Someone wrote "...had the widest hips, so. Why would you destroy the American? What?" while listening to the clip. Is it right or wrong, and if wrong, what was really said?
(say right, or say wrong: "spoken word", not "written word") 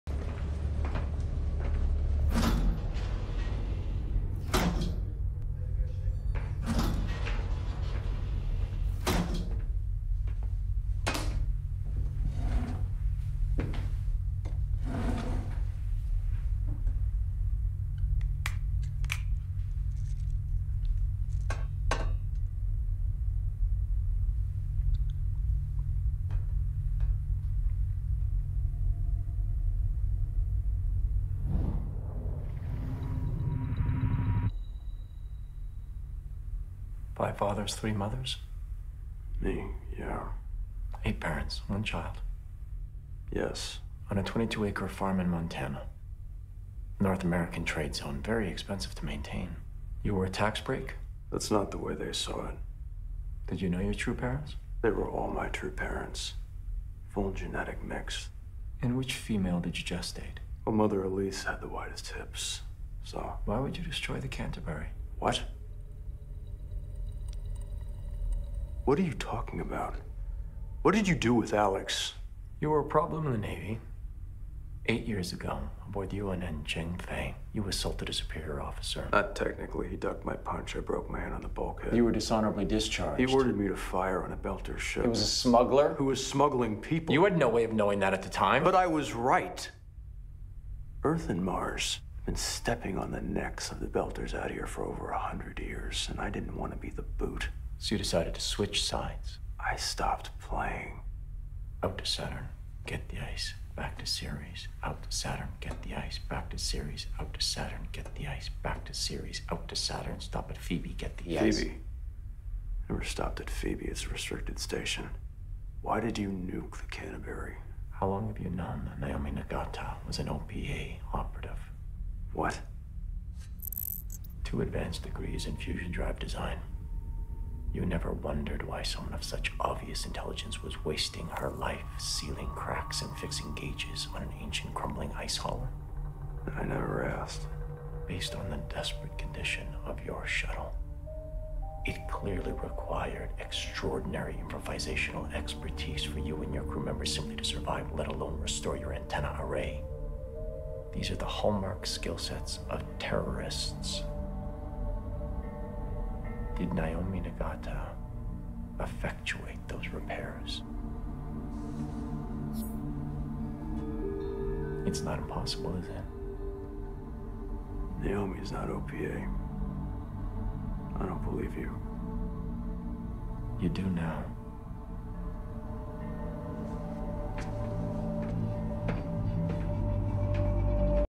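wrong: "Canterbury", not "American".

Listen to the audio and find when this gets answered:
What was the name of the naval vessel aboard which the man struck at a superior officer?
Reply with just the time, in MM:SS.
01:16.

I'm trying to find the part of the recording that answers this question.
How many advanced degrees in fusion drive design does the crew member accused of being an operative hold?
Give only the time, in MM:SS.
02:04.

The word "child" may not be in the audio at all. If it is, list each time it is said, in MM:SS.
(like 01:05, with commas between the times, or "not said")
00:41.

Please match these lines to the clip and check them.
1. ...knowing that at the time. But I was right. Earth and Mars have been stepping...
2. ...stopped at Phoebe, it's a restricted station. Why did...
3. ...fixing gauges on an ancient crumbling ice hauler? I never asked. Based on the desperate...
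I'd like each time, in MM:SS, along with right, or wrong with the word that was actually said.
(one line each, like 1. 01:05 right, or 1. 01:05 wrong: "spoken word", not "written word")
1. 01:27 right
2. 01:53 right
3. 02:13 right.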